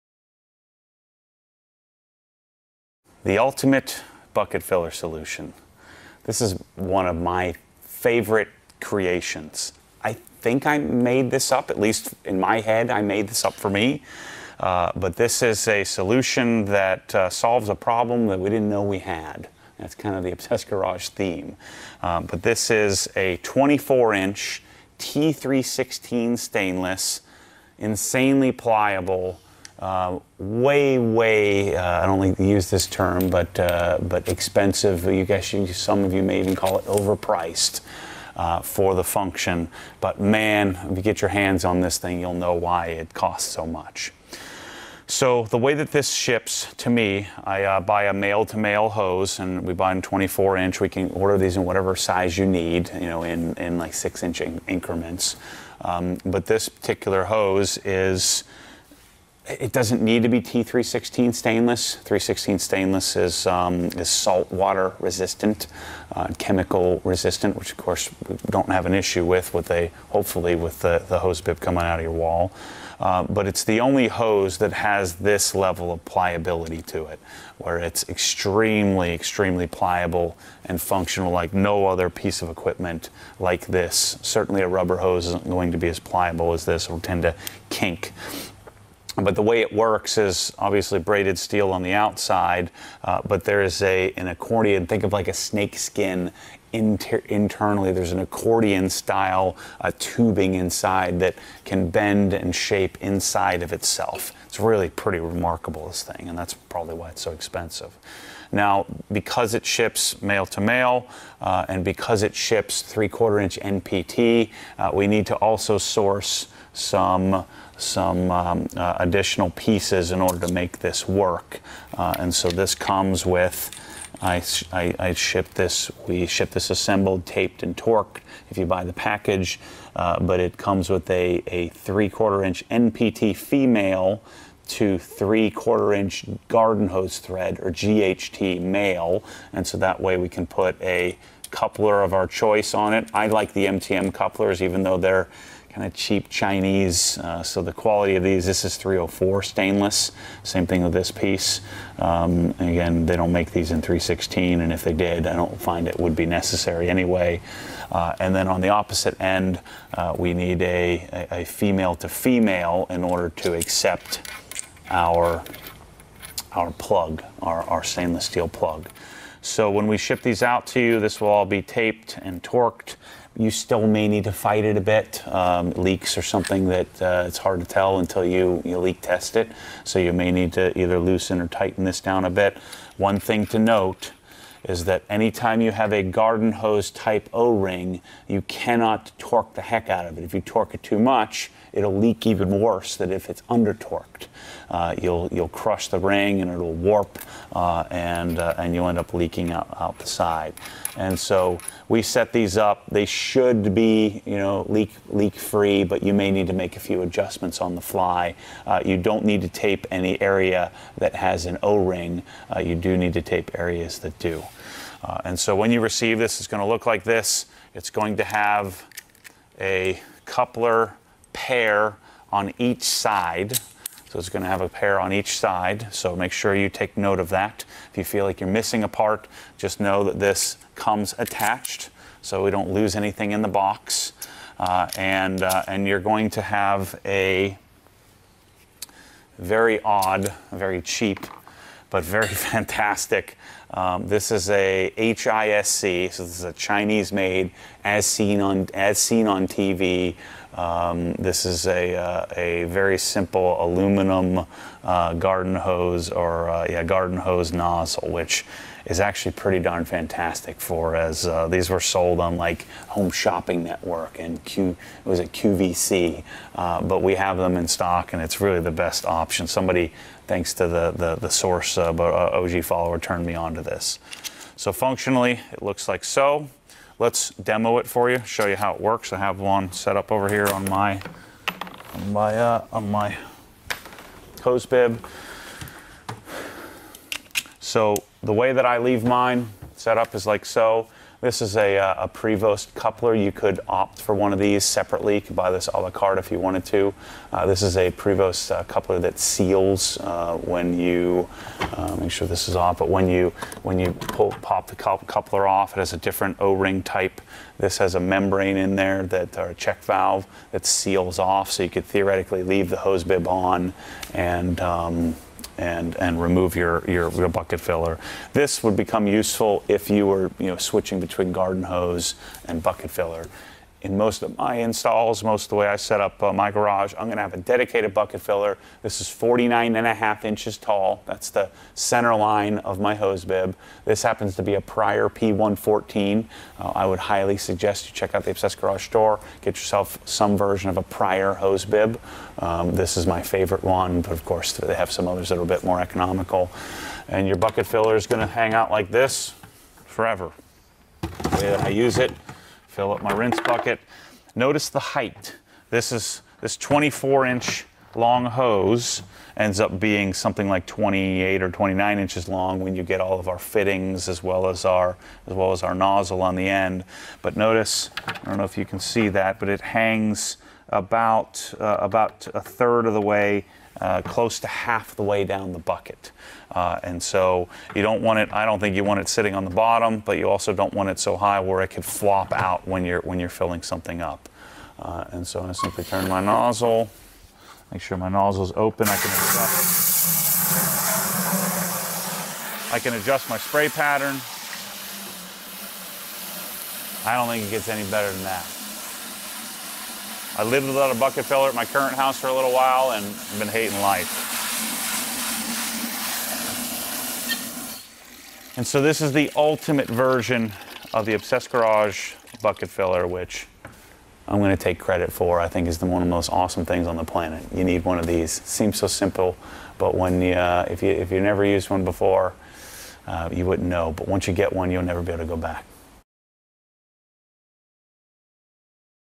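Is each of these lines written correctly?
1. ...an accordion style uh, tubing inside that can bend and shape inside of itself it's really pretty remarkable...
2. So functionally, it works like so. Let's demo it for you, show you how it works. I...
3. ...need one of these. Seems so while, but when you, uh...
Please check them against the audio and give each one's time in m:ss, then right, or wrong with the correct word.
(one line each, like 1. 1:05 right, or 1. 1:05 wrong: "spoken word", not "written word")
1. 1:38 right
2. 4:34 wrong: "looks", not "works"
3. 6:57 wrong: "simple", not "while".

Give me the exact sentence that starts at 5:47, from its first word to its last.
And your bucket filler is gonna hang out like this forever.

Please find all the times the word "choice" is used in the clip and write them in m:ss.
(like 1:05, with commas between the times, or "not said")
2:22.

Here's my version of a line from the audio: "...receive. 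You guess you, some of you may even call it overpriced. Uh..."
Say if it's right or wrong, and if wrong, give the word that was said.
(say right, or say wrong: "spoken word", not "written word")
wrong: "expensive", not "receive".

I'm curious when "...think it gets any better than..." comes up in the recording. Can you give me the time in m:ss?
6:37.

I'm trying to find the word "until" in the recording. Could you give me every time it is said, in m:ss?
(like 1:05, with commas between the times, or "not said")
2:57.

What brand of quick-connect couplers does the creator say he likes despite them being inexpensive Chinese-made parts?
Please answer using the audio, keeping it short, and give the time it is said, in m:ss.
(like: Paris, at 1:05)
MTM, at 2:23.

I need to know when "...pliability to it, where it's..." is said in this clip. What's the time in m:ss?
1:16.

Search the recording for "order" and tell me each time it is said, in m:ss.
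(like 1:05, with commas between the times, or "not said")
0:51, 2:00, 2:43.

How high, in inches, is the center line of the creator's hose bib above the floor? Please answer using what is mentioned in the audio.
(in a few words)
49.5 inches.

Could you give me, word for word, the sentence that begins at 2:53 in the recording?
You still may need to fight it a bit.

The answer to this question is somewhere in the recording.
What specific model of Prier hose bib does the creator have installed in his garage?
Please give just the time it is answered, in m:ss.
5:35.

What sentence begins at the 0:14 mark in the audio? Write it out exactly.
Uh, but this is a solution that uh, solves a problem that we didn't know we had.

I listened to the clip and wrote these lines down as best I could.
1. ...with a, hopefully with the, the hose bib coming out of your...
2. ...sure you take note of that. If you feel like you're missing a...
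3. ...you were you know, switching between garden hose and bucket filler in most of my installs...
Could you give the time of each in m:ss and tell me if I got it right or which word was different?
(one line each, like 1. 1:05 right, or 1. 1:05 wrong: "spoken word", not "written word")
1. 1:09 right
2. 3:46 right
3. 5:19 right.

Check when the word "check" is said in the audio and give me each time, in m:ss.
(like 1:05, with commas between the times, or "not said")
5:09, 5:37.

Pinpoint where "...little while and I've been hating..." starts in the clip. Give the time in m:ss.
6:42.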